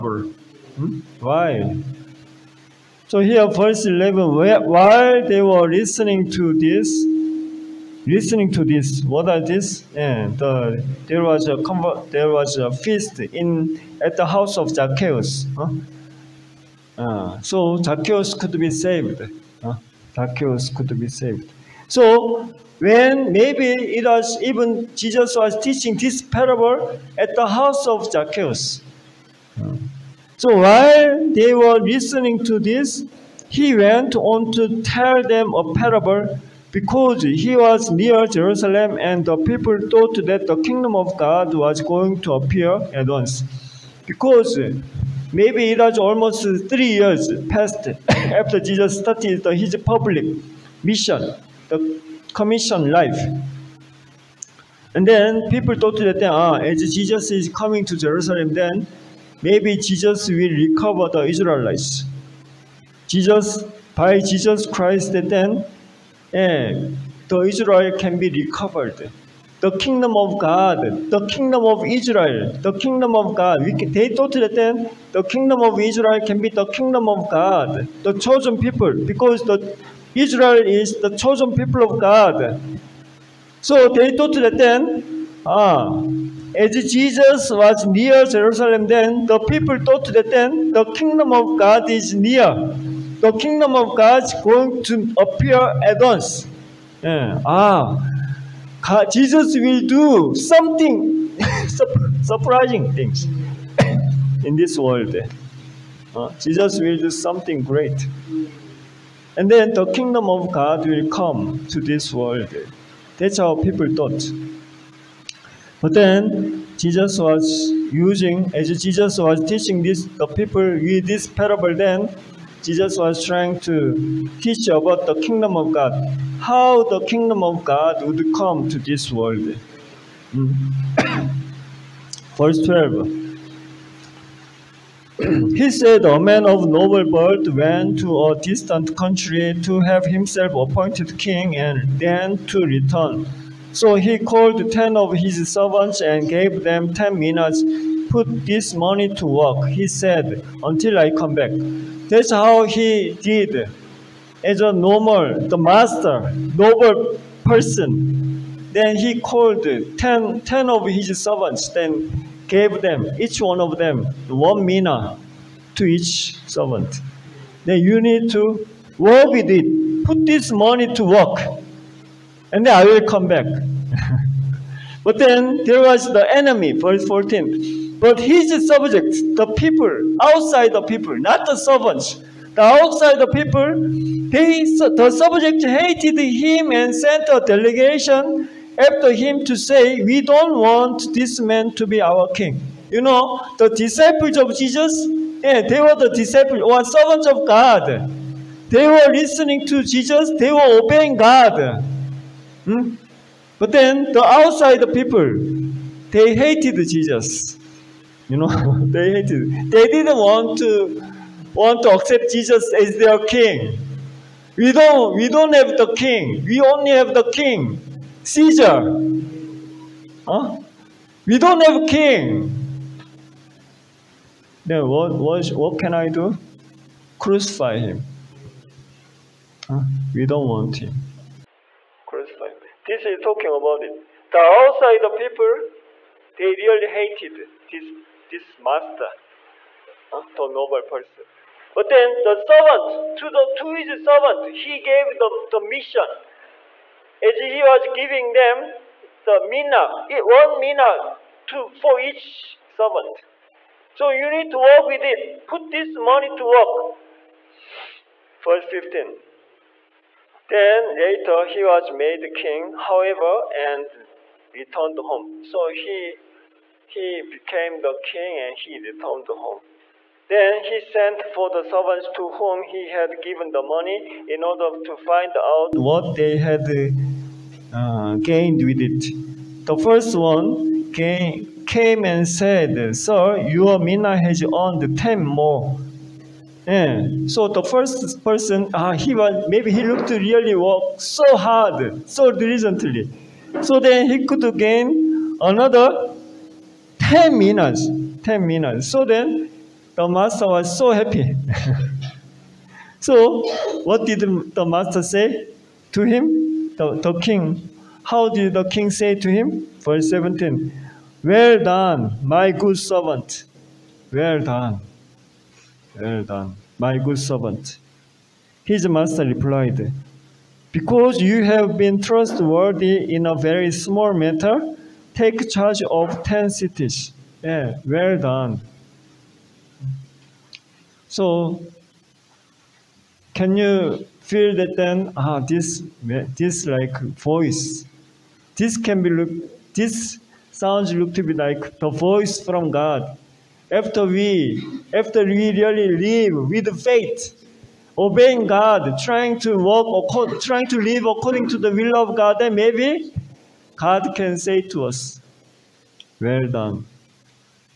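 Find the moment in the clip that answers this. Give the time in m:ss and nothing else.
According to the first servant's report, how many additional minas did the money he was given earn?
4:44.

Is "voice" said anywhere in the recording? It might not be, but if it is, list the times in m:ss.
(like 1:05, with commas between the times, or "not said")
5:37, 5:41.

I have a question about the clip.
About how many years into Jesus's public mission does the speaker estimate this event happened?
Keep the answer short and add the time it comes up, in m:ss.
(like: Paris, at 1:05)
3, at 0:45.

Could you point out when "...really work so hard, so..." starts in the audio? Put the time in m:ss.
4:50.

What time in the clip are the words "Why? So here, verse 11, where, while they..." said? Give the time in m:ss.
0:01.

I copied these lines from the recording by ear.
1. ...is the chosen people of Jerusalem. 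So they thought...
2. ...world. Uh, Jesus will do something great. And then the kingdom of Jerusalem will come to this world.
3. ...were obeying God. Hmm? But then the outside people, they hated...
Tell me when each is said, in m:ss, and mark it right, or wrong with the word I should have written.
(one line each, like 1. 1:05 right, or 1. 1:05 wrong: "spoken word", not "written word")
1. 1:20 wrong: "God", not "Jerusalem"
2. 1:44 wrong: "God", not "Jerusalem"
3. 3:20 right.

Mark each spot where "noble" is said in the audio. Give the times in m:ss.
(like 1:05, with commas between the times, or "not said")
2:16, 2:36, 4:00.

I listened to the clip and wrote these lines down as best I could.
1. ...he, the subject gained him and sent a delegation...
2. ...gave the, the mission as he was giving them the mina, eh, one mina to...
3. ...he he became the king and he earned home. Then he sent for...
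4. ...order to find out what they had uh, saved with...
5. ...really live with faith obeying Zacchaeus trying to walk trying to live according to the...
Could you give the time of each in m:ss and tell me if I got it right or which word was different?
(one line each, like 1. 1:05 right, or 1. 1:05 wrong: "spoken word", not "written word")
1. 3:03 wrong: "hated", not "gained"
2. 4:04 right
3. 4:25 wrong: "returned", not "earned"
4. 4:34 wrong: "gained", not "saved"
5. 5:45 wrong: "God", not "Zacchaeus".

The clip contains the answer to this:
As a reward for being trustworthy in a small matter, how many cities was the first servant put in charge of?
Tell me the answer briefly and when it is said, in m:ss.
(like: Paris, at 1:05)
10, at 5:26.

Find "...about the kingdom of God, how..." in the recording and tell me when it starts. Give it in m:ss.
2:04.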